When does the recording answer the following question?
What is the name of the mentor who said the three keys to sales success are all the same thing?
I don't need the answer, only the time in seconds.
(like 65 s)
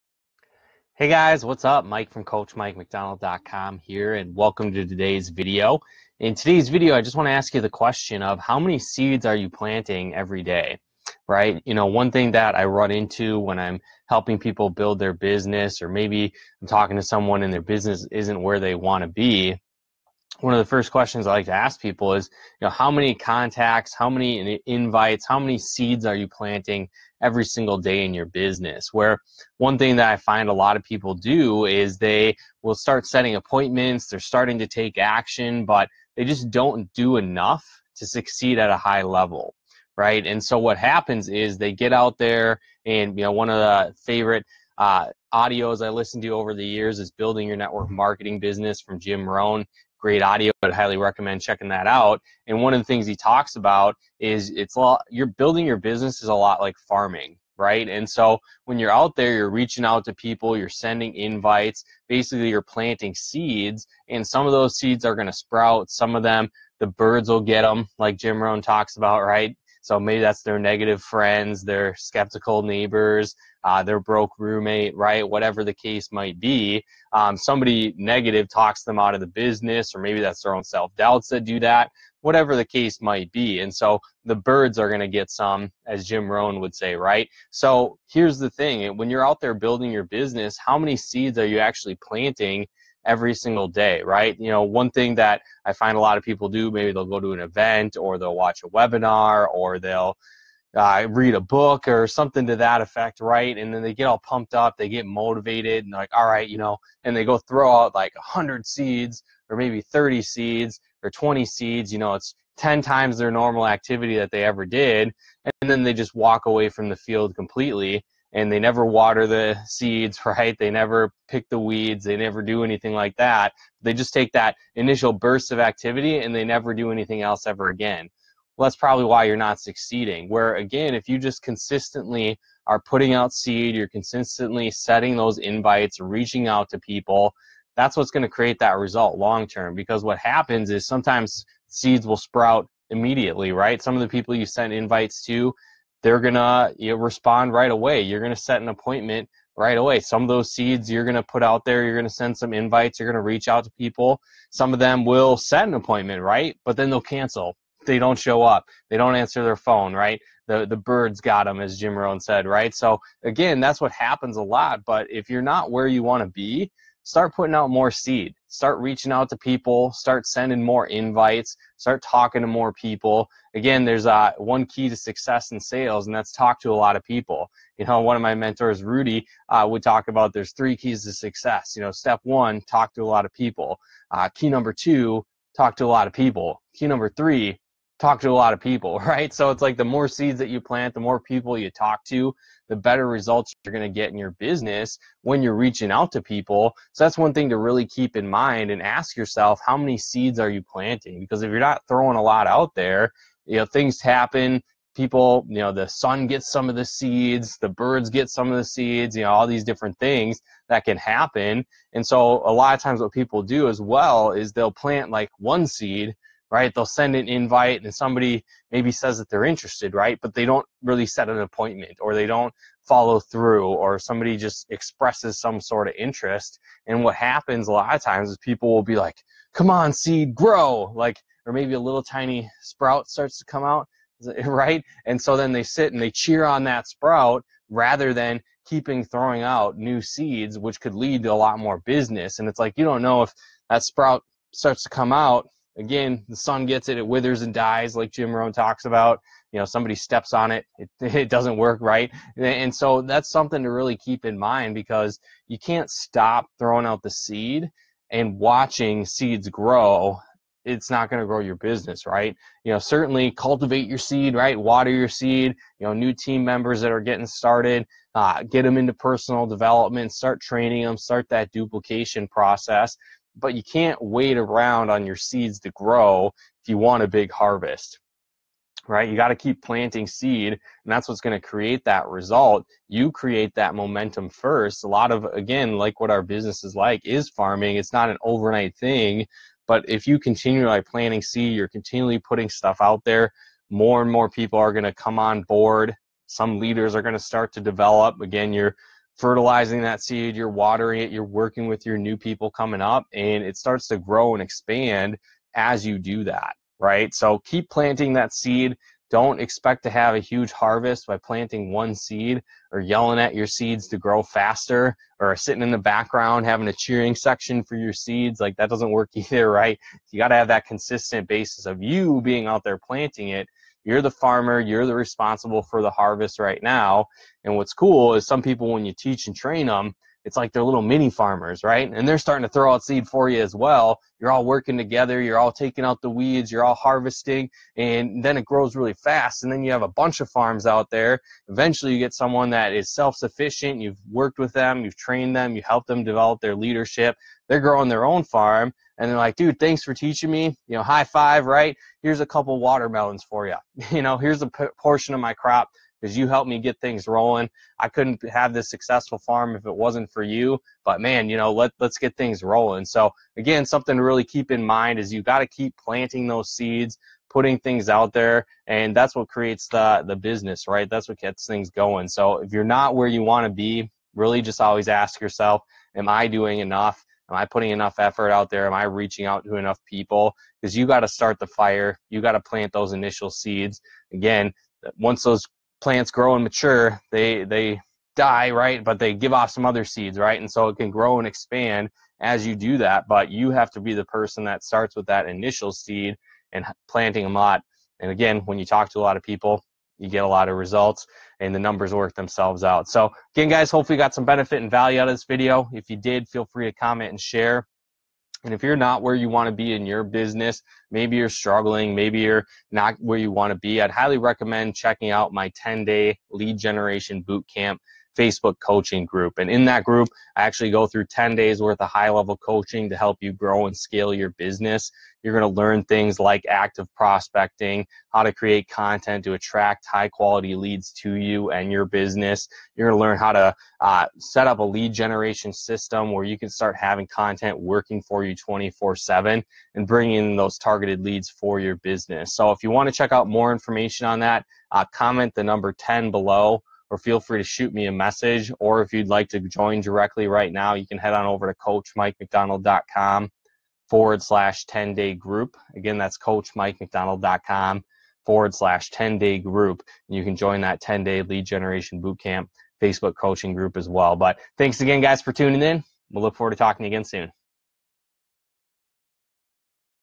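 178 s.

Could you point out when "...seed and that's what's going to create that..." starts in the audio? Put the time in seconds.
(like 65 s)
280 s.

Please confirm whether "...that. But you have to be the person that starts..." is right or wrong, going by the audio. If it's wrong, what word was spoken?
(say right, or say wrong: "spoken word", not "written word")
right.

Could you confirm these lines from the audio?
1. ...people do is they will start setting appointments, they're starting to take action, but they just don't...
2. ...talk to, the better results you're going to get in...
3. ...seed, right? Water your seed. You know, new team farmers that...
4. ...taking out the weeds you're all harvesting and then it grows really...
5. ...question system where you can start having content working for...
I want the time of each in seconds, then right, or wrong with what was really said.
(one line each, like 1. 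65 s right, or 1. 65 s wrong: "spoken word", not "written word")
1. 30 s right
2. 191 s right
3. 263 s wrong: "members", not "farmers"
4. 335 s right
5. 434 s wrong: "generation", not "question".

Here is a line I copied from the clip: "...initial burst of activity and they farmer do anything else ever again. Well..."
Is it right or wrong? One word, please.
wrong.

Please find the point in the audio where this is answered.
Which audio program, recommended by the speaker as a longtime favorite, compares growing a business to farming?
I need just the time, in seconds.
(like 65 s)
47 s.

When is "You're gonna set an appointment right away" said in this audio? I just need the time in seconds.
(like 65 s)
148 s.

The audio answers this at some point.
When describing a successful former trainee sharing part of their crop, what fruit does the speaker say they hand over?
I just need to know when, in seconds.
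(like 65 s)
352 s.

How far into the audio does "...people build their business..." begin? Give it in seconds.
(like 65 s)
14 s.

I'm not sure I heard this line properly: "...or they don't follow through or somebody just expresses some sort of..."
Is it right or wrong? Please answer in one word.
right.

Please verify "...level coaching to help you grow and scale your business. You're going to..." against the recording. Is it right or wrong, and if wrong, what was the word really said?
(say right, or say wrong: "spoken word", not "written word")
right.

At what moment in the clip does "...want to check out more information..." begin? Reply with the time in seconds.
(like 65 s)
442 s.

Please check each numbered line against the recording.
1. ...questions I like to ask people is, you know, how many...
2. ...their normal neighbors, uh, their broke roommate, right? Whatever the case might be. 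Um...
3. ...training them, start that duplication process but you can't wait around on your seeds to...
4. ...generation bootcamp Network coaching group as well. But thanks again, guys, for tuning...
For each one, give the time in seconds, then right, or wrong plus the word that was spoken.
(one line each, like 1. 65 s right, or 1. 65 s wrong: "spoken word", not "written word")
1. 20 s right
2. 71 s wrong: "skeptical", not "normal"
3. 270 s right
4. 461 s wrong: "Facebook", not "Network".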